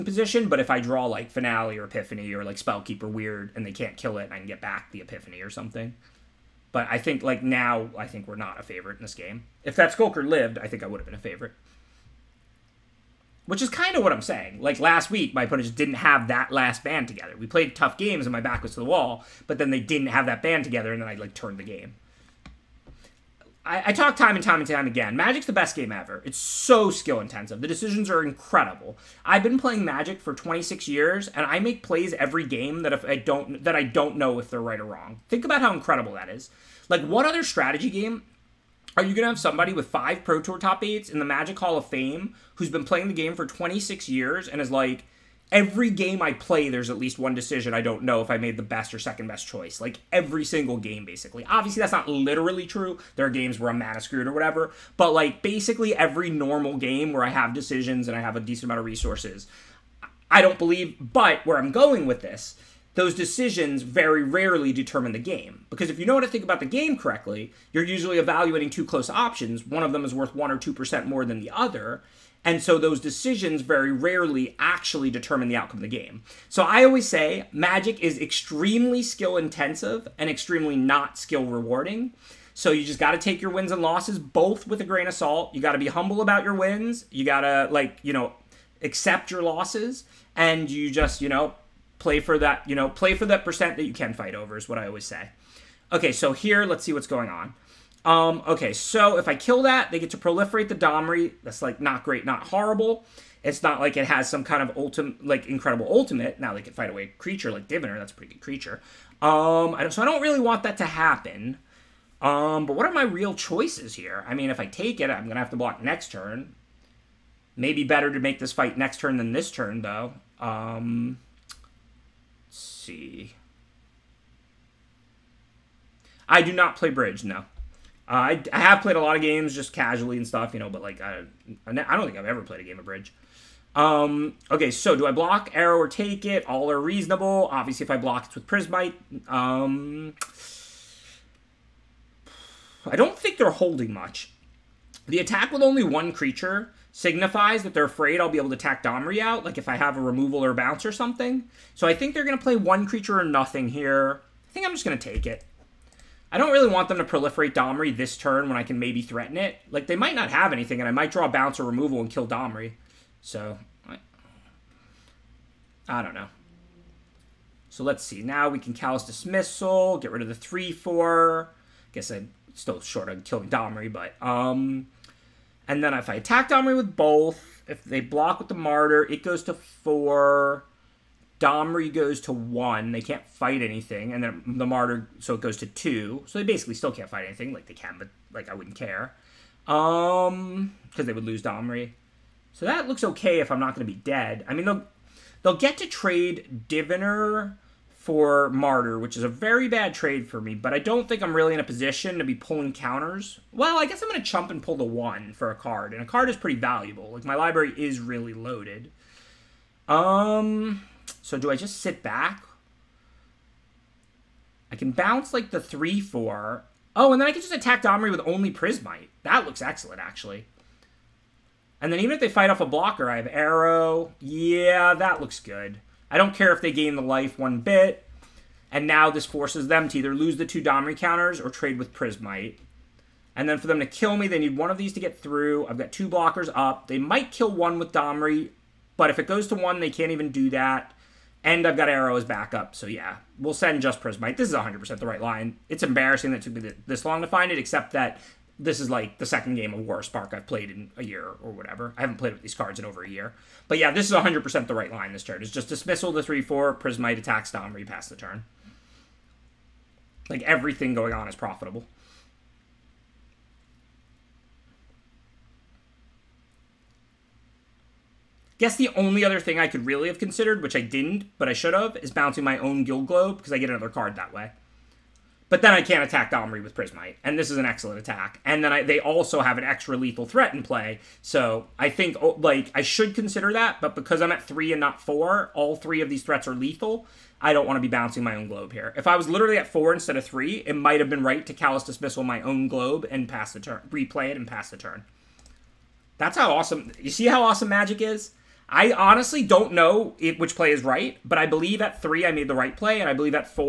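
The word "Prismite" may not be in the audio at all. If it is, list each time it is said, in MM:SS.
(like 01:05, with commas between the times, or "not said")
02:18, 03:38, 03:51, 04:04, 04:16, 04:36.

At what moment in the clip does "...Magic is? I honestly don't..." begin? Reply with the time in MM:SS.
04:57.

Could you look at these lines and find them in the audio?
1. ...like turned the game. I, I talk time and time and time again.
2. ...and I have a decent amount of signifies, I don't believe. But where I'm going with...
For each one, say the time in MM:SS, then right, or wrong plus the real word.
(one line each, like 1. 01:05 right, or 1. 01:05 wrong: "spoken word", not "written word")
1. 00:21 right
2. 00:58 wrong: "resources", not "signifies".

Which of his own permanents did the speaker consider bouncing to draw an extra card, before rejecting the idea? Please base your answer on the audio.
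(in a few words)
Guild Globe.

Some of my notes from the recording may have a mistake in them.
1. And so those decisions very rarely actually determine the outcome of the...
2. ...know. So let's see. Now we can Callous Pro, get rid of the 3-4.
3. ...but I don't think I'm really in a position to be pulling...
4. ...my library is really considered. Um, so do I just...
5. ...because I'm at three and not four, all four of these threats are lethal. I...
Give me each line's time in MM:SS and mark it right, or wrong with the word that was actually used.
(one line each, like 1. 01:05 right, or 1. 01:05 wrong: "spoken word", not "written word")
1. 01:12 right
2. 02:46 wrong: "Dismissal", not "Pro"
3. 03:20 right
4. 03:27 wrong: "loaded", not "considered"
5. 04:43 wrong: "three", not "four".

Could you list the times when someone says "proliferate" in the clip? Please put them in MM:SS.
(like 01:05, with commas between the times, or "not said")
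01:40, 02:37.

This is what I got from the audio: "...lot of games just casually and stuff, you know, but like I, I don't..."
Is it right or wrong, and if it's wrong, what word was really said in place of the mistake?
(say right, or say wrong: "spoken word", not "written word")
right.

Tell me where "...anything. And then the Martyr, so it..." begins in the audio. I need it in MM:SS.
03:03.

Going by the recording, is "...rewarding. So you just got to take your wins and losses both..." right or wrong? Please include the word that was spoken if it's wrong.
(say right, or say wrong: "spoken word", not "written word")
right.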